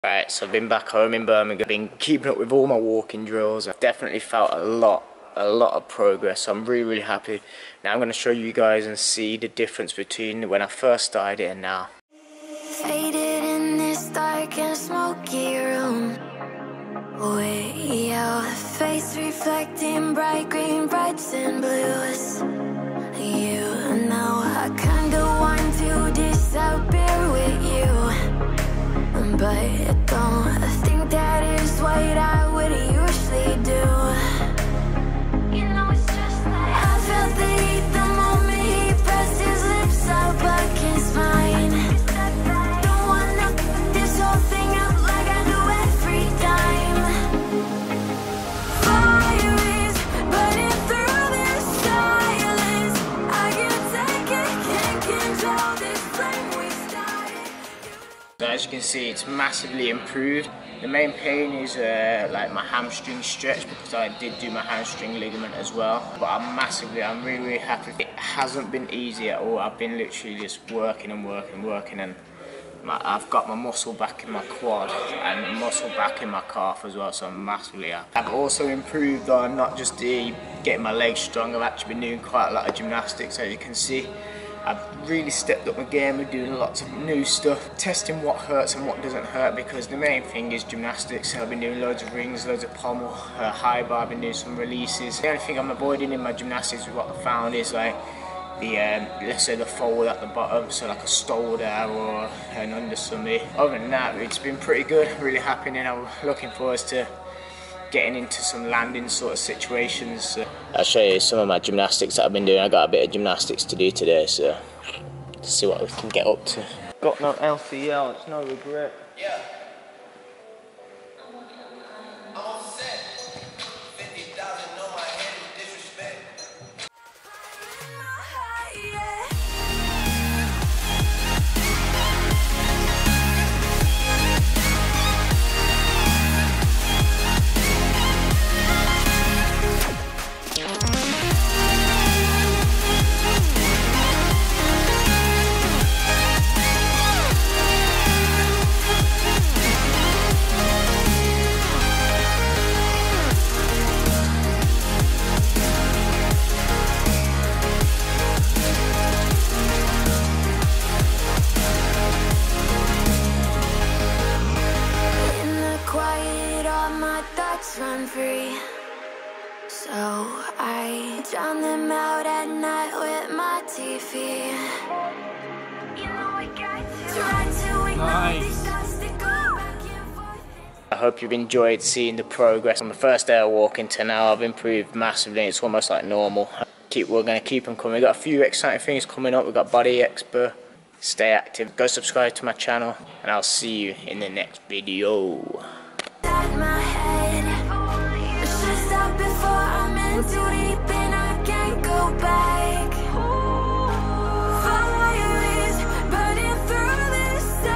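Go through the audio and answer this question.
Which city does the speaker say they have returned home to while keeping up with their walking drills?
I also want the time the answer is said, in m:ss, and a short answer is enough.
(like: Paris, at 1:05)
Birmingham, at 0:01.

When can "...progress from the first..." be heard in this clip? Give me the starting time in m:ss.
3:02.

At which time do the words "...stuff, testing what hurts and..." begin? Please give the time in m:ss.
1:27.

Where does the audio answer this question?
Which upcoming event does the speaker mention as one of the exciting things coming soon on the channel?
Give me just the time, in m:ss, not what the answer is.
3:09.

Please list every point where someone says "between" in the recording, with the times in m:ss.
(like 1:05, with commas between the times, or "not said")
0:09.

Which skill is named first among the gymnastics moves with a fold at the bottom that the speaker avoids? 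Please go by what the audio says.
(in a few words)
Stalder.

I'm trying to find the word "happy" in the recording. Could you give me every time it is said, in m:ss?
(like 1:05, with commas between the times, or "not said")
0:07, 1:07, 1:45.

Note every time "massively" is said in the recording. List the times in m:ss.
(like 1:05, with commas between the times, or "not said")
0:59, 1:06, 1:17, 3:04.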